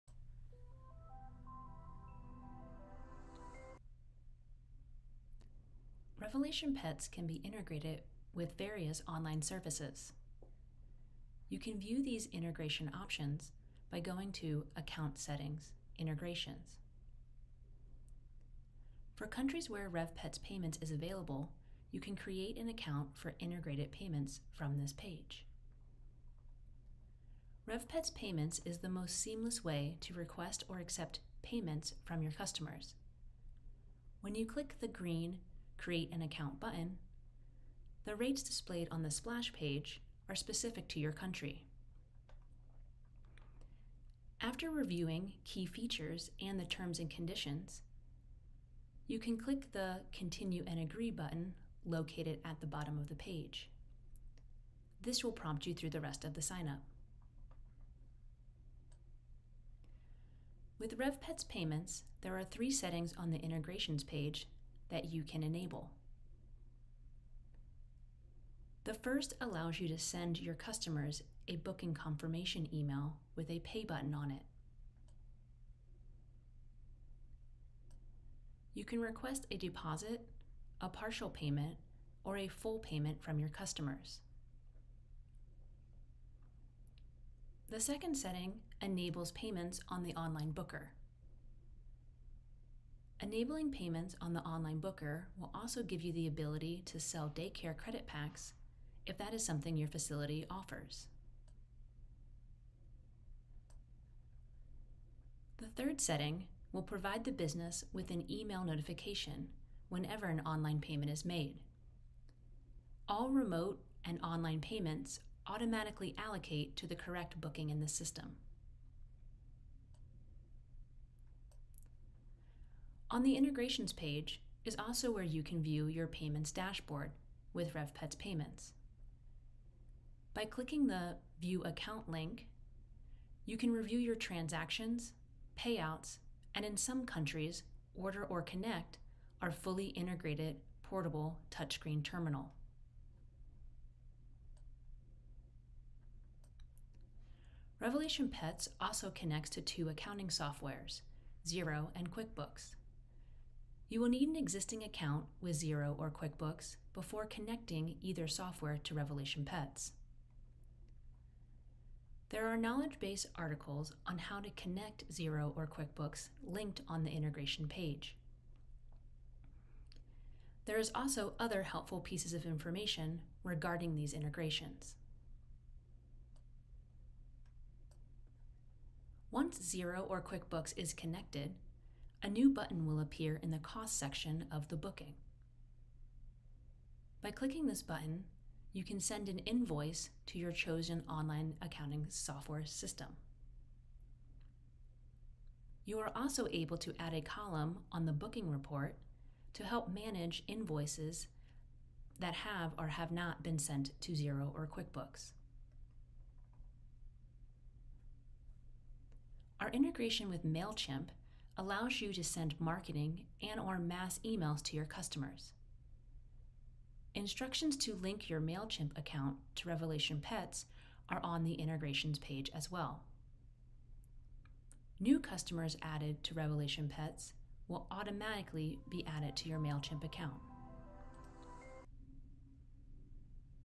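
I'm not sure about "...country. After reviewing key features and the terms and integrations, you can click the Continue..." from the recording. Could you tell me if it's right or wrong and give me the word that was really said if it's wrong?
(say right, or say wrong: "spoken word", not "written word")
wrong: "conditions", not "integrations".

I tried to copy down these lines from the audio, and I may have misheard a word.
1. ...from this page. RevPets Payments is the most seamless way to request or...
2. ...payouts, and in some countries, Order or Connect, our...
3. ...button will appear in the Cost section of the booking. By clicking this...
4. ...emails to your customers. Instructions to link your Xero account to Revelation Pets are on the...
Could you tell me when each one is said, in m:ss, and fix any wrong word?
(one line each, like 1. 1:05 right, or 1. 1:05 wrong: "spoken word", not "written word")
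1. 0:24 right
2. 2:15 right
3. 3:02 right
4. 3:34 wrong: "MailChimp", not "Xero".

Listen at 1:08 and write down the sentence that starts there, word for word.
The first allows you to send your customers a booking confirmation email with a pay button on it.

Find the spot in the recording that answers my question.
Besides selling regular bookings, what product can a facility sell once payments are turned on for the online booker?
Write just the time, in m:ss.
1:37.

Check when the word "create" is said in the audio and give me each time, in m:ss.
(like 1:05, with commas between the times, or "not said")
0:22, 0:35.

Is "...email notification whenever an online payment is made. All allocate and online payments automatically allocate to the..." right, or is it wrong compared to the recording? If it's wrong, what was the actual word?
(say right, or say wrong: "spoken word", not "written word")
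wrong: "remote", not "allocate".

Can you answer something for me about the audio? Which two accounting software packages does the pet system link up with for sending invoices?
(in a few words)
Xero and QuickBooks.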